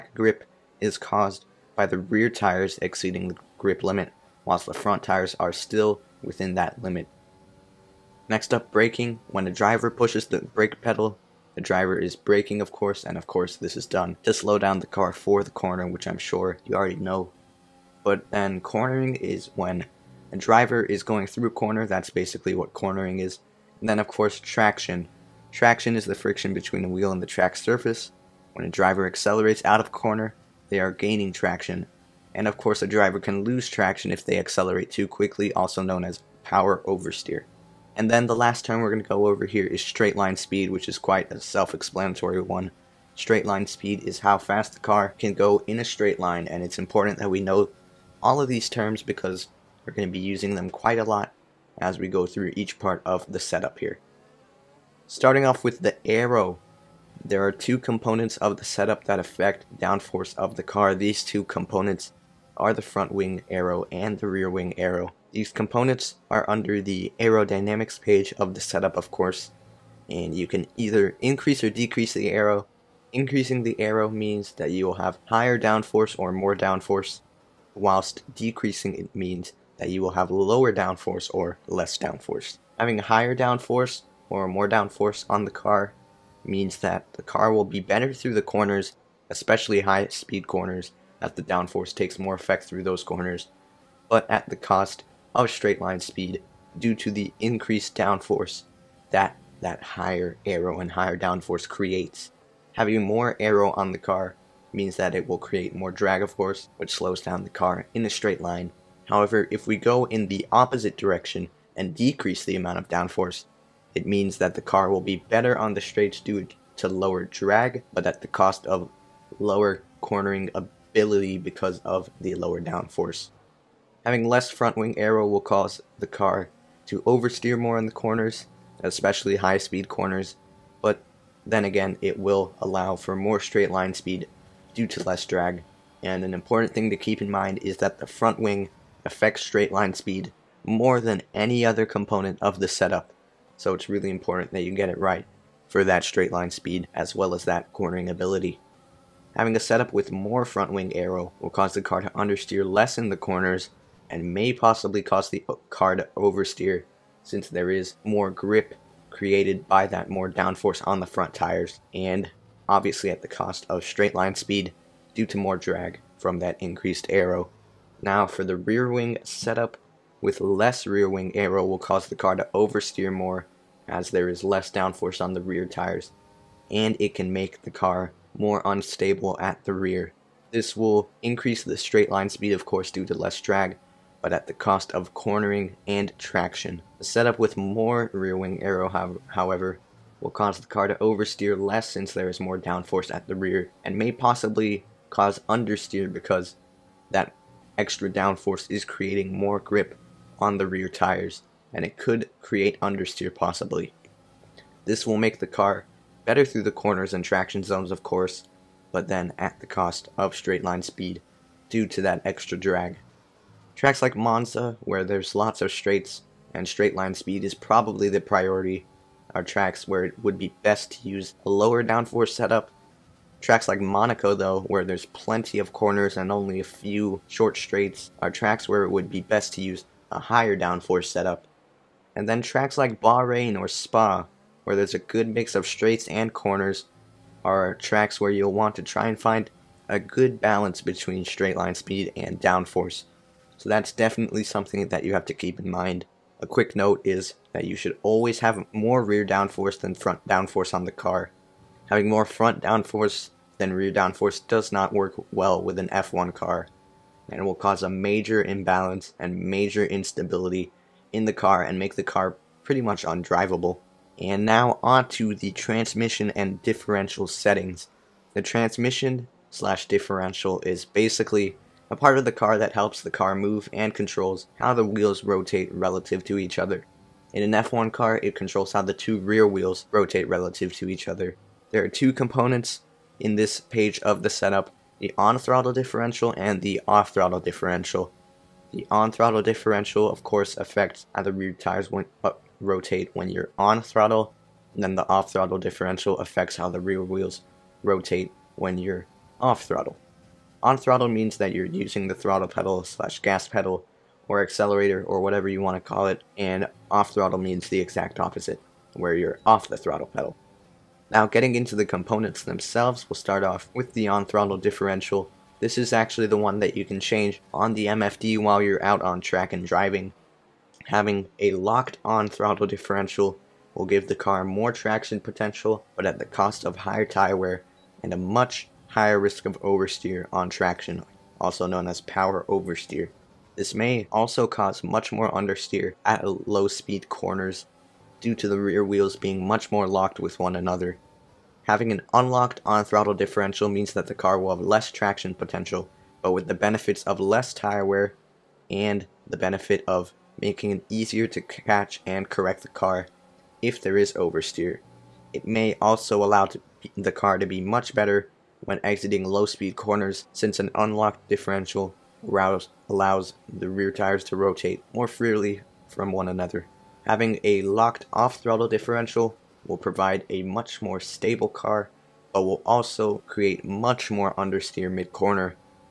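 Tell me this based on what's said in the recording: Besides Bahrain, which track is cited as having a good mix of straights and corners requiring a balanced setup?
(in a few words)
Spa.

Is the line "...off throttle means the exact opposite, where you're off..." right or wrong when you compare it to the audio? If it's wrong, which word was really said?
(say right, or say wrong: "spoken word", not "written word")
right.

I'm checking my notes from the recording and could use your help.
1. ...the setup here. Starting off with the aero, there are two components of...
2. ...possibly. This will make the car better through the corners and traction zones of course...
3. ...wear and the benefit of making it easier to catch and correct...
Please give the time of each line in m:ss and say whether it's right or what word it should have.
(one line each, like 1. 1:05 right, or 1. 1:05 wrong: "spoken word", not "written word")
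1. 0:53 right
2. 3:23 right
3. 5:47 right.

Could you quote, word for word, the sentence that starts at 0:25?
Traction is the friction between the wheel and the track surface.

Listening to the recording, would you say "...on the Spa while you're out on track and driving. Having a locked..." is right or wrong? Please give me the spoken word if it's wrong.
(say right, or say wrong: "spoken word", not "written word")
wrong: "MFD", not "Spa".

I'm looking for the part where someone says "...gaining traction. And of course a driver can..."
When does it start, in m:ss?
0:30.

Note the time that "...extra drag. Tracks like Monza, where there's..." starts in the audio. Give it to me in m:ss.
3:32.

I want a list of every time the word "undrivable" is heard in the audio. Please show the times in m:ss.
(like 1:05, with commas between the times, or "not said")
4:23.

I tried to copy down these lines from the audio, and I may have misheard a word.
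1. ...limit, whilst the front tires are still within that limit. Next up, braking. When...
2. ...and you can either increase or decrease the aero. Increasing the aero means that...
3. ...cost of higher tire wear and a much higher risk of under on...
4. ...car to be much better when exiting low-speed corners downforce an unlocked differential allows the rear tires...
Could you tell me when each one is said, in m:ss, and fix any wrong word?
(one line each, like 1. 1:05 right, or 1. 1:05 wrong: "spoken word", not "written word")
1. 0:03 right
2. 1:10 right
3. 5:26 wrong: "oversteer", not "under"
4. 5:57 wrong: "since", not "downforce".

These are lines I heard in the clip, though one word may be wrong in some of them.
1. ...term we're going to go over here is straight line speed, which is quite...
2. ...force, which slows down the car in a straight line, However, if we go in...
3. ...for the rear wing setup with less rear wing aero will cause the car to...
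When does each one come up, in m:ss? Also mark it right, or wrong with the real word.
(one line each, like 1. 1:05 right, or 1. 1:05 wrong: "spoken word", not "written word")
1. 0:38 right
2. 1:46 right
3. 2:48 right.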